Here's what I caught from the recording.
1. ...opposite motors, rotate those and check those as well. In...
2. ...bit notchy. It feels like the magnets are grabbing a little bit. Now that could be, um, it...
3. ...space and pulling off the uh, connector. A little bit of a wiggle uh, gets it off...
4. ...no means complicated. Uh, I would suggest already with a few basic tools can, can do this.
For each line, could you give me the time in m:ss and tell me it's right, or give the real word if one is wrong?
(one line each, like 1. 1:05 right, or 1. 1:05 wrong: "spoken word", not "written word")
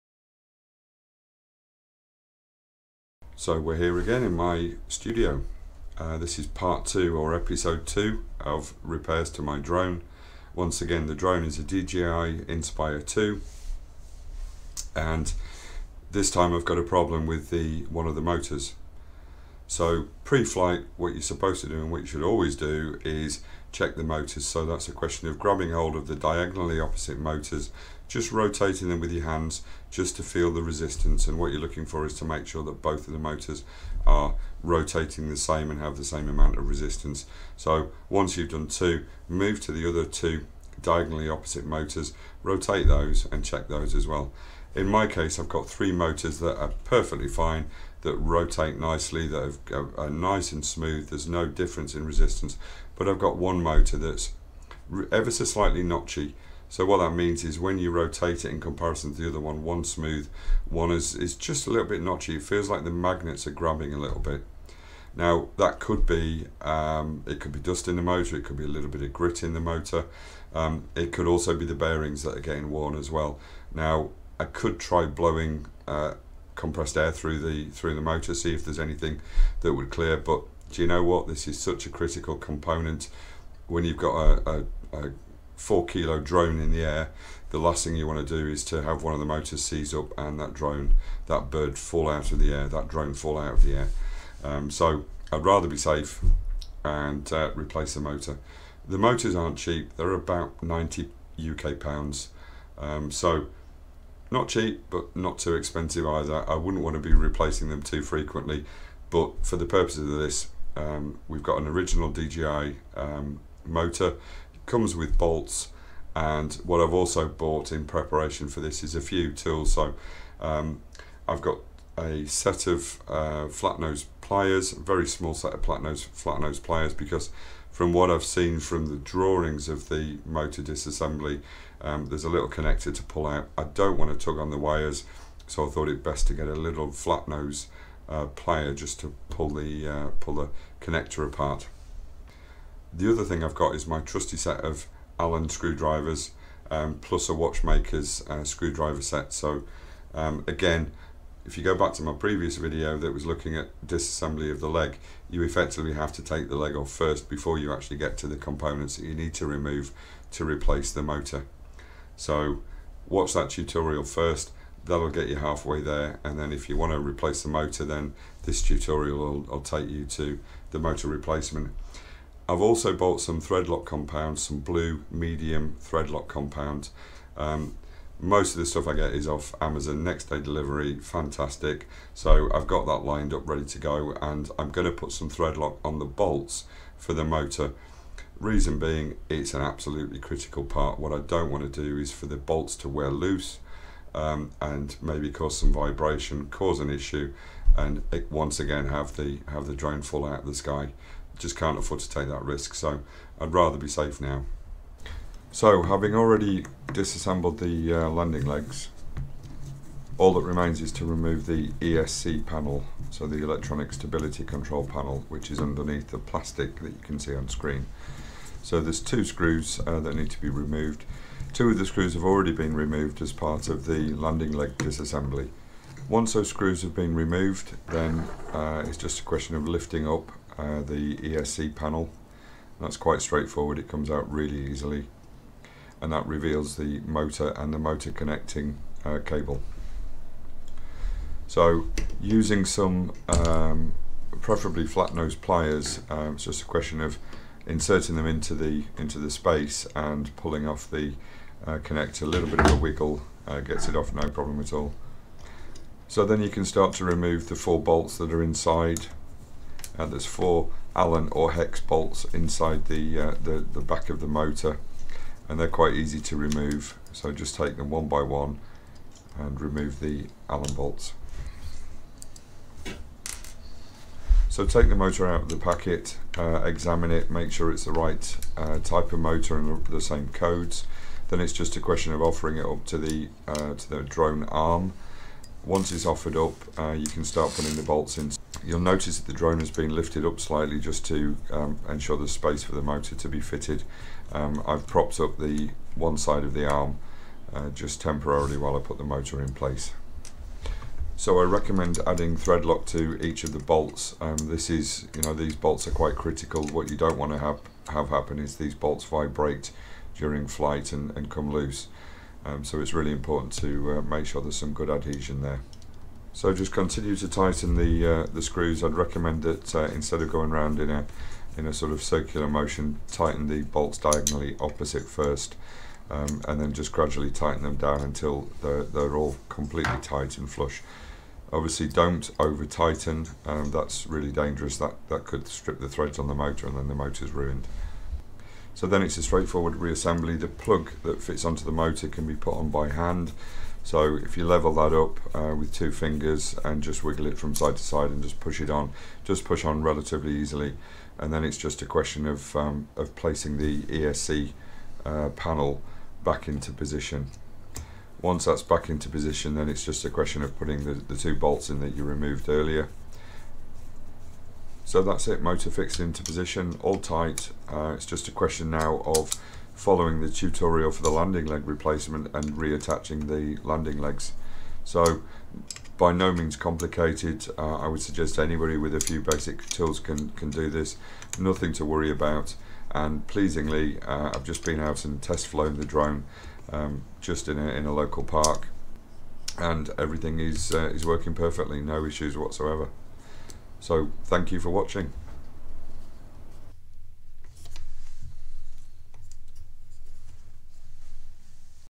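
1. 0:41 right
2. 1:01 right
3. 4:09 right
4. 6:16 wrong: "anybody", not "already".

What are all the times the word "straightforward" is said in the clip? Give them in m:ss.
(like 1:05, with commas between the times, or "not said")
3:53, 5:39.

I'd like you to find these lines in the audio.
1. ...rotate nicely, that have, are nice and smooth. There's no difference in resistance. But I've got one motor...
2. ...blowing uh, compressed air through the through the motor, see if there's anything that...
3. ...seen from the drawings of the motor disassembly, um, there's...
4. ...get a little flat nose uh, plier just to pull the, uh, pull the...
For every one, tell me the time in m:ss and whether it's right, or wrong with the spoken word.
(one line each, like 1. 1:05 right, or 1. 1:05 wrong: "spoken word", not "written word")
1. 0:48 right
2. 1:15 right
3. 2:08 right
4. 2:16 right.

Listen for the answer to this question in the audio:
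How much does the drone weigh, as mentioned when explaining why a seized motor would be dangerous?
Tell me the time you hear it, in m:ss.
1:25.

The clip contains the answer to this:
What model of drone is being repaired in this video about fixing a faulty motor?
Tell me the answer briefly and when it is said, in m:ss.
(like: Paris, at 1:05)
DJI Inspire 2, at 0:11.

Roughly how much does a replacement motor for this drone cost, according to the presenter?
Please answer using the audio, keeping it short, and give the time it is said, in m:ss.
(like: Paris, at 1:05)
90 UK pounds, at 1:40.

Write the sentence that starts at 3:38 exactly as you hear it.
So there's two screws uh, that need to be removed.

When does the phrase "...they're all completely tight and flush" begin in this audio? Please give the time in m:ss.
5:28.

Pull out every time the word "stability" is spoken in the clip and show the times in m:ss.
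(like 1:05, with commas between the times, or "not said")
3:33.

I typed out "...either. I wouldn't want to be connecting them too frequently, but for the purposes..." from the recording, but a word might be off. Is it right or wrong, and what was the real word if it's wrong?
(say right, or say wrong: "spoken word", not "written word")
wrong: "replacing", not "connecting".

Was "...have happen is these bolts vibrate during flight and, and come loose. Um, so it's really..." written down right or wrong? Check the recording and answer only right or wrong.
right.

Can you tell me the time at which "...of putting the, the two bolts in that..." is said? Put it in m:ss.
6:00.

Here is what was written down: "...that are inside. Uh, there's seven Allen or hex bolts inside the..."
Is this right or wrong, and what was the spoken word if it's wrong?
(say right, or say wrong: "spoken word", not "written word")
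wrong: "four", not "seven".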